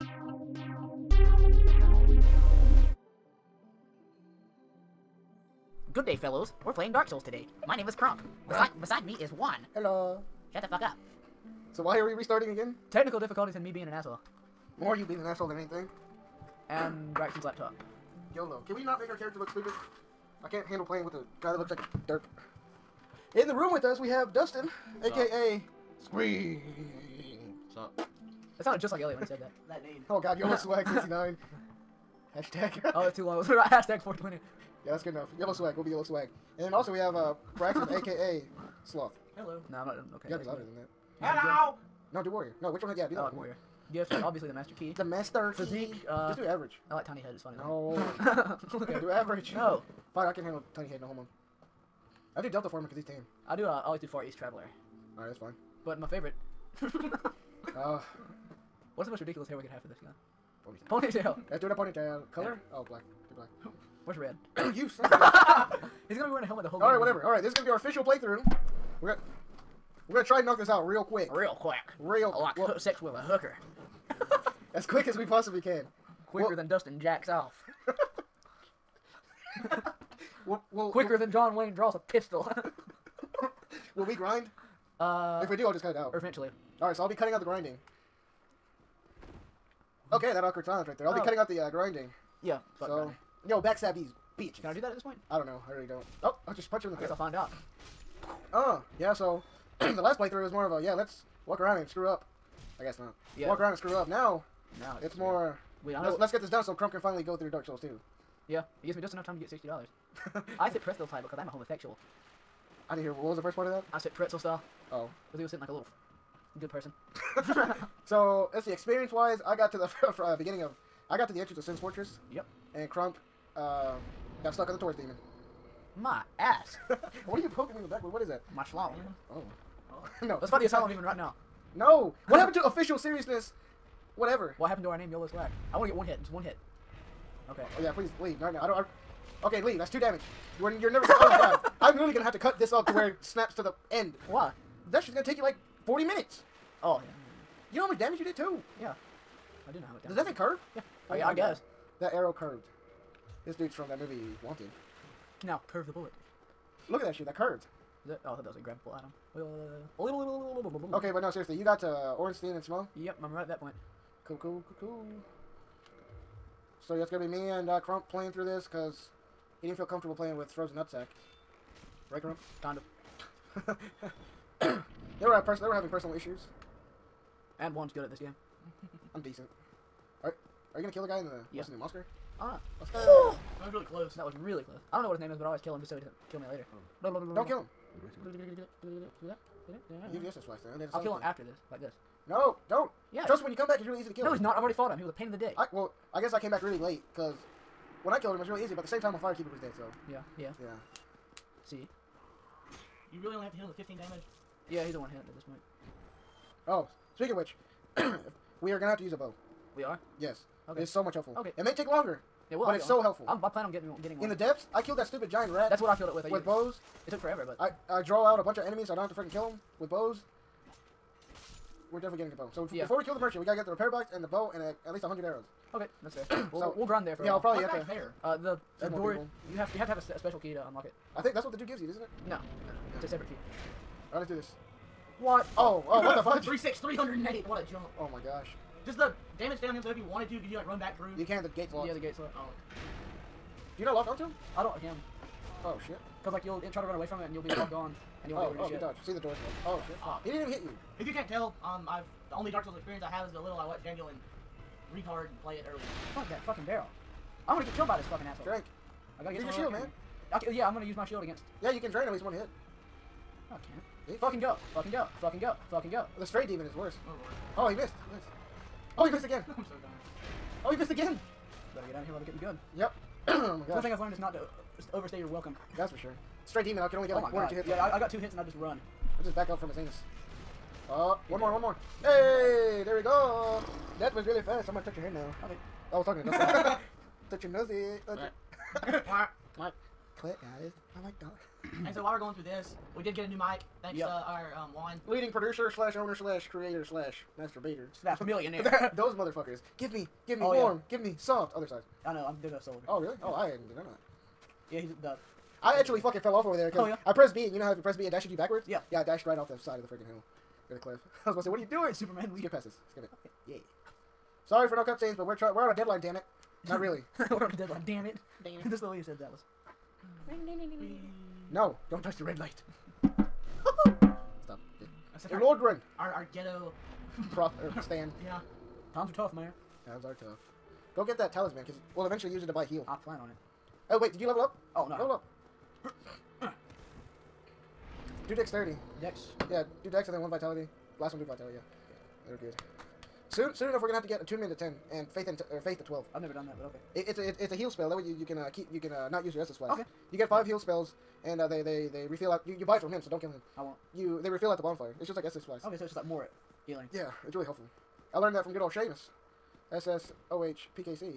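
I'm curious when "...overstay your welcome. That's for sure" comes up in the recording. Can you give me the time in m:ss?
4:34.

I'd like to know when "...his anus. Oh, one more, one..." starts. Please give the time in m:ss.
4:39.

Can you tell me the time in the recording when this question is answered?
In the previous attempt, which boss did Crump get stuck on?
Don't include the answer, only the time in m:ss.
2:04.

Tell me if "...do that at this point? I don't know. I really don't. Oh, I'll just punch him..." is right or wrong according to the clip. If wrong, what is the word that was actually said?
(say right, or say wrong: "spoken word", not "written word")
right.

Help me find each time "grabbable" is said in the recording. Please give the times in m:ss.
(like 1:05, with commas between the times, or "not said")
2:38.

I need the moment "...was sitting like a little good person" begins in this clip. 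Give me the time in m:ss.
1:55.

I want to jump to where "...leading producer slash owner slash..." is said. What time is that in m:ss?
4:55.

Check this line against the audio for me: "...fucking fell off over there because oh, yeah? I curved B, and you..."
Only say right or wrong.
wrong.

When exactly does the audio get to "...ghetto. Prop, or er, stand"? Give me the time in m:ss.
5:26.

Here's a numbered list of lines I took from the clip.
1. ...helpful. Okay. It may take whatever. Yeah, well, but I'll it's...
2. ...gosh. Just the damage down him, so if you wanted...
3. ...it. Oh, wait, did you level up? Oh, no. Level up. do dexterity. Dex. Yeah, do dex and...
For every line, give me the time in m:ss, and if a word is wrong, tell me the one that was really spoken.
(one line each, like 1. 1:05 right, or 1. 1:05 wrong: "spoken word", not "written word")
1. 3:31 wrong: "longer", not "whatever"
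2. 3:58 right
3. 5:33 right.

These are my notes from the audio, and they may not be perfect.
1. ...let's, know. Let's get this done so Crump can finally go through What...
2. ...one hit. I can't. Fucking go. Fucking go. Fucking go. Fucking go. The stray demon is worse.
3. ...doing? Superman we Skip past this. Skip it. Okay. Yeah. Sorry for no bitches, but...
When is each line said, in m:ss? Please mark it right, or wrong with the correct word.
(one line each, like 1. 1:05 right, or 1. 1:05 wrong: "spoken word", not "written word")
1. 1:46 wrong: "Dark", not "What"
2. 4:22 right
3. 5:11 wrong: "cutscenes", not "bitches".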